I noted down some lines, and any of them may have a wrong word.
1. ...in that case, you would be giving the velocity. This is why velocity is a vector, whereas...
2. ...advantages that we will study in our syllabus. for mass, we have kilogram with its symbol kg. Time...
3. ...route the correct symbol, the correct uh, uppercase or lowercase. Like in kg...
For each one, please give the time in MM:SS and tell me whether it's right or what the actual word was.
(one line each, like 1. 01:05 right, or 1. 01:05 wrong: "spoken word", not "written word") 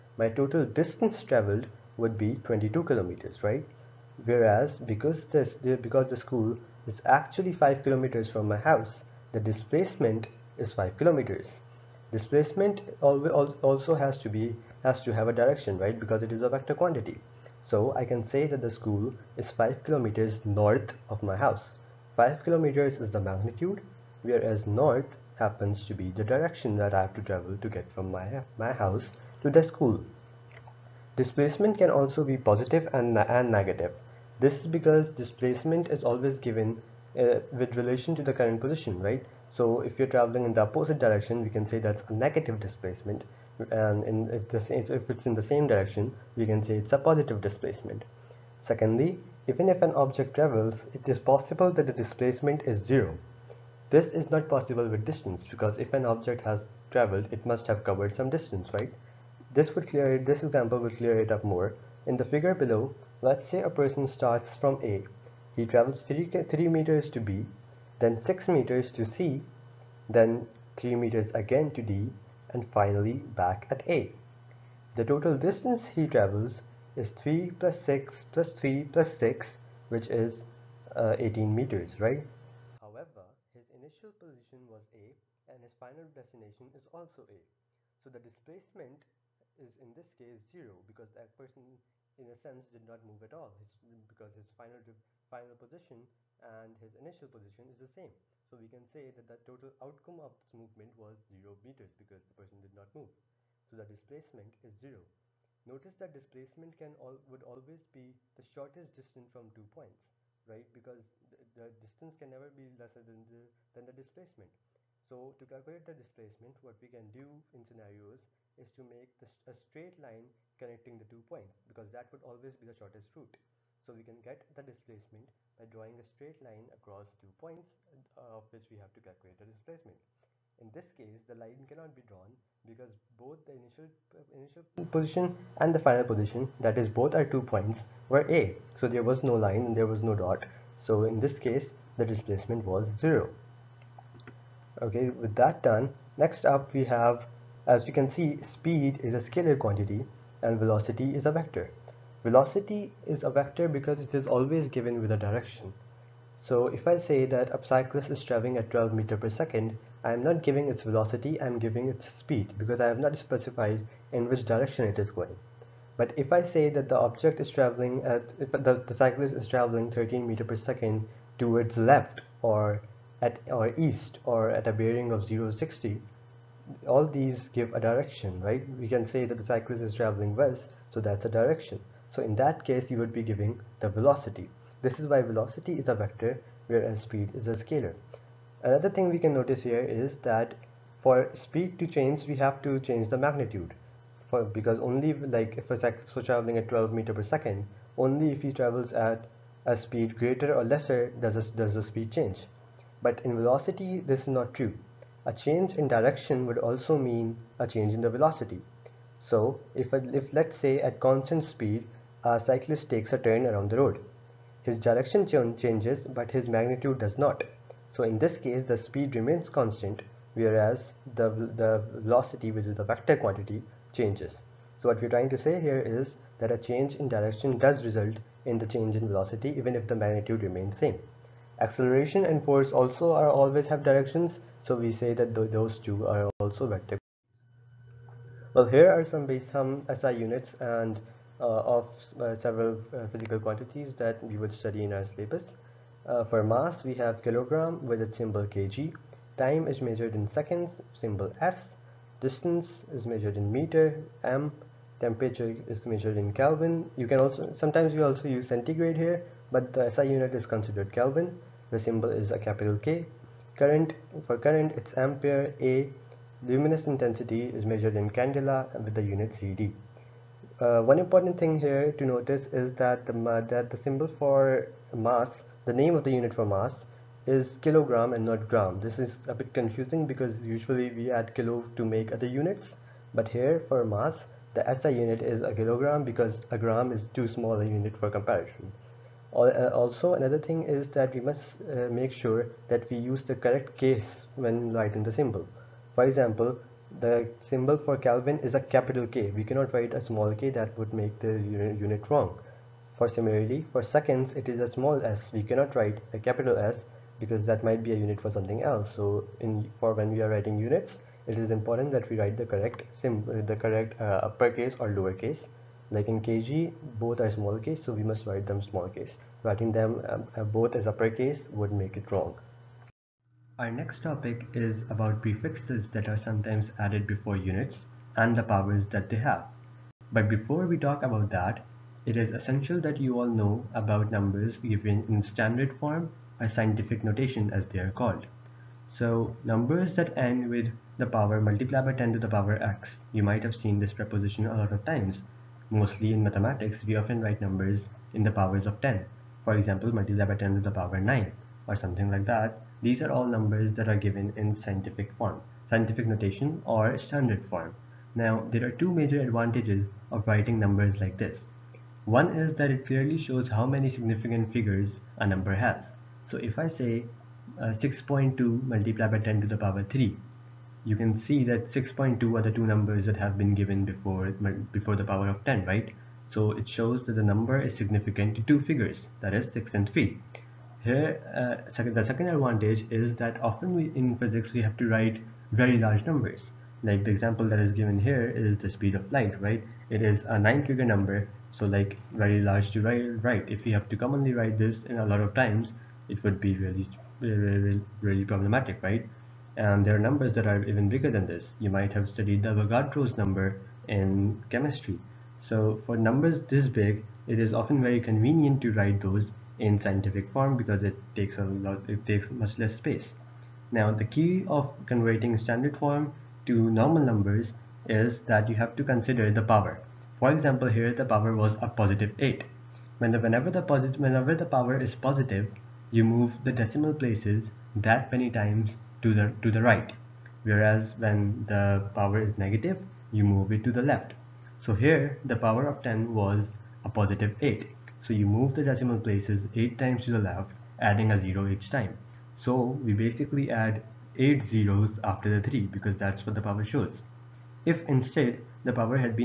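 1. 03:02 right
2. 04:03 wrong: "quantities", not "advantages"
3. 05:12 wrong: "write", not "route".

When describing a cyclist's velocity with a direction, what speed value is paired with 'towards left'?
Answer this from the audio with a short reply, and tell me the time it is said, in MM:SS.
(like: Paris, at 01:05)
13 meters per second, at 02:49.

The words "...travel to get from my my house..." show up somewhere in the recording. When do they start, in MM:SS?
00:27.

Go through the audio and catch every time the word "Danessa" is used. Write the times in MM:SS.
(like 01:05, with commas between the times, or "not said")
not said.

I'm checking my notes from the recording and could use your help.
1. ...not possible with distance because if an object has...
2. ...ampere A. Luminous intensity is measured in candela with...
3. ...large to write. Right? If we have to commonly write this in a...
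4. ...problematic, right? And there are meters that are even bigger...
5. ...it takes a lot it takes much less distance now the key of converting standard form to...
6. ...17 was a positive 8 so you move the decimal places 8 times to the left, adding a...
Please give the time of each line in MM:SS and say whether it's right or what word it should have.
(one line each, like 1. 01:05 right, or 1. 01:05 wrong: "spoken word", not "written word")
1. 00:54 right
2. 04:24 right
3. 06:32 right
4. 06:38 wrong: "numbers", not "meters"
5. 06:50 wrong: "space", not "distance"
6. 07:15 wrong: "10", not "17".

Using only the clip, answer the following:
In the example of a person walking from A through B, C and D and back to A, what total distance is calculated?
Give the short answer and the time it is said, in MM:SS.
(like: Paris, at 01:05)
18 meters, at 01:21.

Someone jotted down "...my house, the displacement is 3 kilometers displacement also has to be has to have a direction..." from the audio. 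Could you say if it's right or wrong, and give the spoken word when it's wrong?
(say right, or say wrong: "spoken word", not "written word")
wrong: "5", not "3".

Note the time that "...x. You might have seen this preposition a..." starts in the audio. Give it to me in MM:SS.
05:42.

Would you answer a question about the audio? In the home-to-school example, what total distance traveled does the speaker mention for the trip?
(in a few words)
22 kilometers.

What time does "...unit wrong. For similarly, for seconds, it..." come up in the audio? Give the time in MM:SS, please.
05:01.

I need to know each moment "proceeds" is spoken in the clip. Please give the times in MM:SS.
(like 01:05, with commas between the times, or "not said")
not said.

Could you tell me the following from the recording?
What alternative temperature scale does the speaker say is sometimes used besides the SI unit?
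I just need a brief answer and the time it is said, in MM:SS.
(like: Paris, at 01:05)
centigrade, at 04:18.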